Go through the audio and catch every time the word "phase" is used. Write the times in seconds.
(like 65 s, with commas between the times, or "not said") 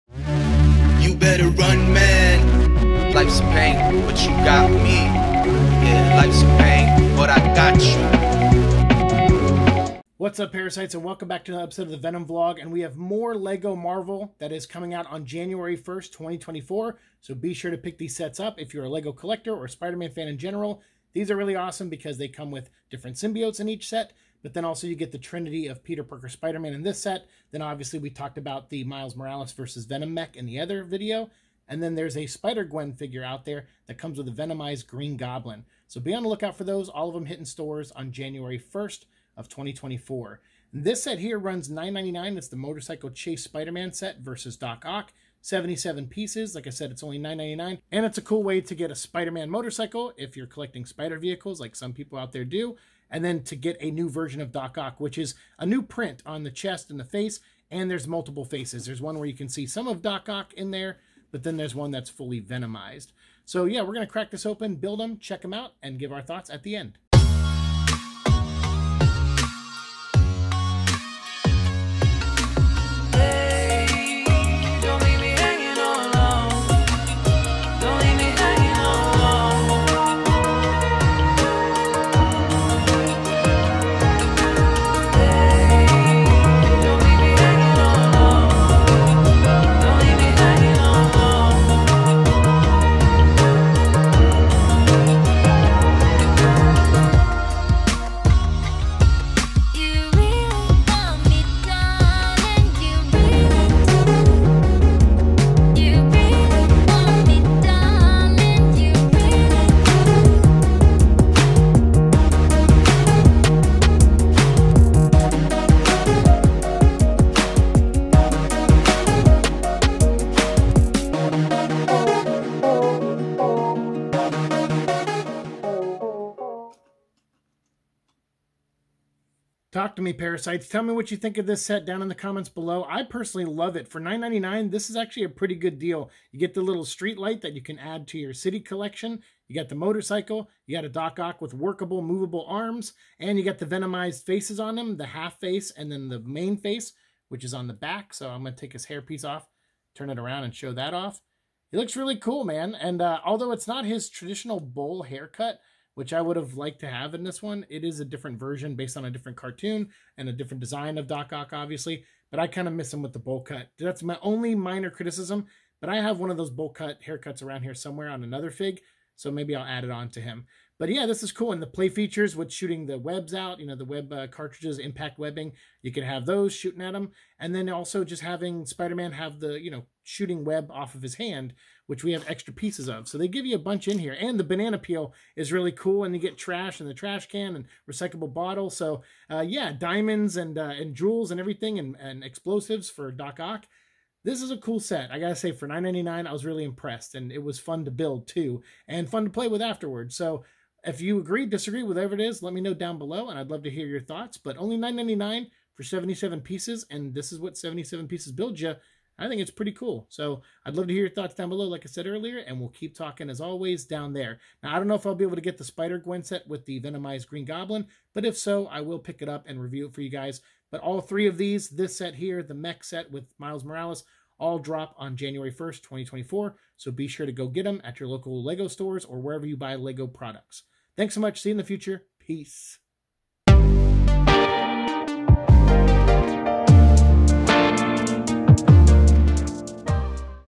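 not said.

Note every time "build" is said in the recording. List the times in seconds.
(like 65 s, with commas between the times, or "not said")
64 s, 197 s, 208 s.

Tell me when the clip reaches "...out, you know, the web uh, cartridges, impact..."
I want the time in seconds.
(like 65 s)
173 s.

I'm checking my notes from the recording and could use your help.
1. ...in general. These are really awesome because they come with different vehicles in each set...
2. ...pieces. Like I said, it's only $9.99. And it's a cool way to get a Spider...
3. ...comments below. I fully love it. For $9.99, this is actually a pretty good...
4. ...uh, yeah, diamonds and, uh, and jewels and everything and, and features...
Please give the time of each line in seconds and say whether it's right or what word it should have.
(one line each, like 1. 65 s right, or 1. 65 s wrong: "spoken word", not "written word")
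1. 20 s wrong: "symbiotes", not "vehicles"
2. 46 s right
3. 132 s wrong: "personally", not "fully"
4. 189 s wrong: "explosives", not "features".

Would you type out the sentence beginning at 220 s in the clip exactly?
But all three of these, this set here, the mech set with Miles Morales, all drop on January 1st, 2024.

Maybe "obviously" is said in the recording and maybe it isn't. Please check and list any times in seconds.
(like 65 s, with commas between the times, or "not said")
27 s, 161 s.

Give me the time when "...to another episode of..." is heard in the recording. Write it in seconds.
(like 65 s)
11 s.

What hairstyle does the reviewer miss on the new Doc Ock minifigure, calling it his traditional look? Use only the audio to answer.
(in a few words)
bowl haircut.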